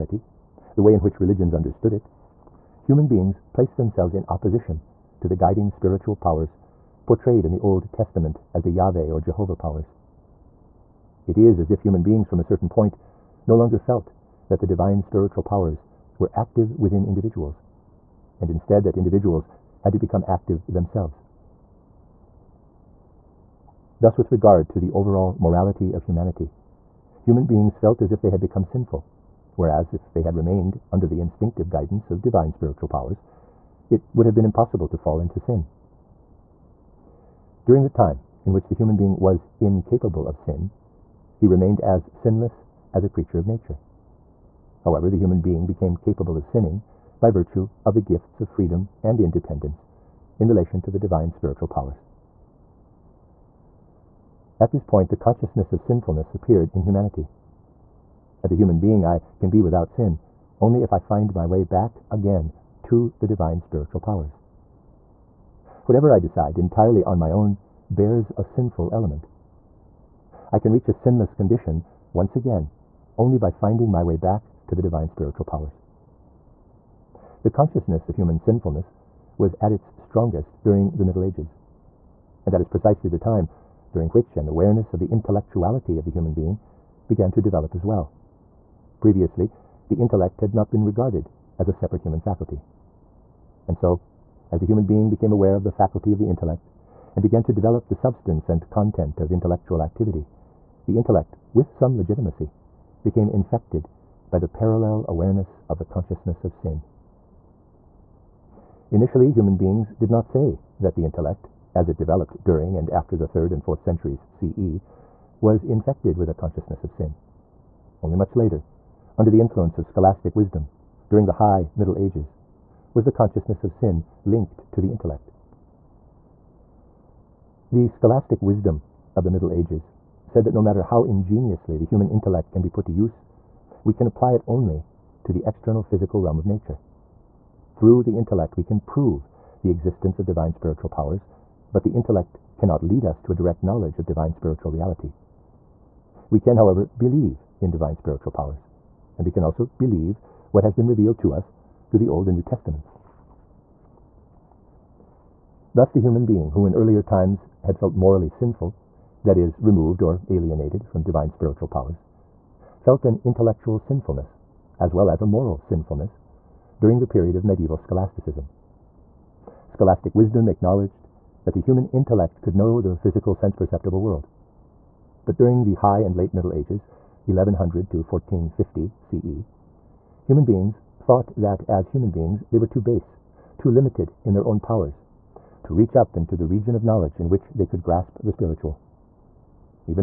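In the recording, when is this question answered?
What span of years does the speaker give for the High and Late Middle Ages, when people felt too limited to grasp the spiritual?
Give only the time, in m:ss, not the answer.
2:57.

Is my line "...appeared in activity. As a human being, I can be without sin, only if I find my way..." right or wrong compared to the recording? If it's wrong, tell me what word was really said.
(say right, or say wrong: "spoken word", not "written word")
wrong: "humanity", not "activity".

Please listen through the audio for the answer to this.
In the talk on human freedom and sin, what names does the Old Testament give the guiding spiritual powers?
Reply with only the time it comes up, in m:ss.
0:08.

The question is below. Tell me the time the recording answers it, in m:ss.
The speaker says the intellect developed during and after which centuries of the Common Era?
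1:53.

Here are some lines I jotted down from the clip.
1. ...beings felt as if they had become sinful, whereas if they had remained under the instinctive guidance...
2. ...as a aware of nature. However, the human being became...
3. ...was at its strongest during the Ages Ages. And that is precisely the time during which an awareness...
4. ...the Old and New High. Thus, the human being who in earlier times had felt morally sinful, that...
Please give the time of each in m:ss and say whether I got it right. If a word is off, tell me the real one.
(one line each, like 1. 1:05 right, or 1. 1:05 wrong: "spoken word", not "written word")
1. 0:27 right
2. 0:42 wrong: "creature", not "aware"
3. 1:19 wrong: "Middle", not "Ages"
4. 2:31 wrong: "Testaments", not "High".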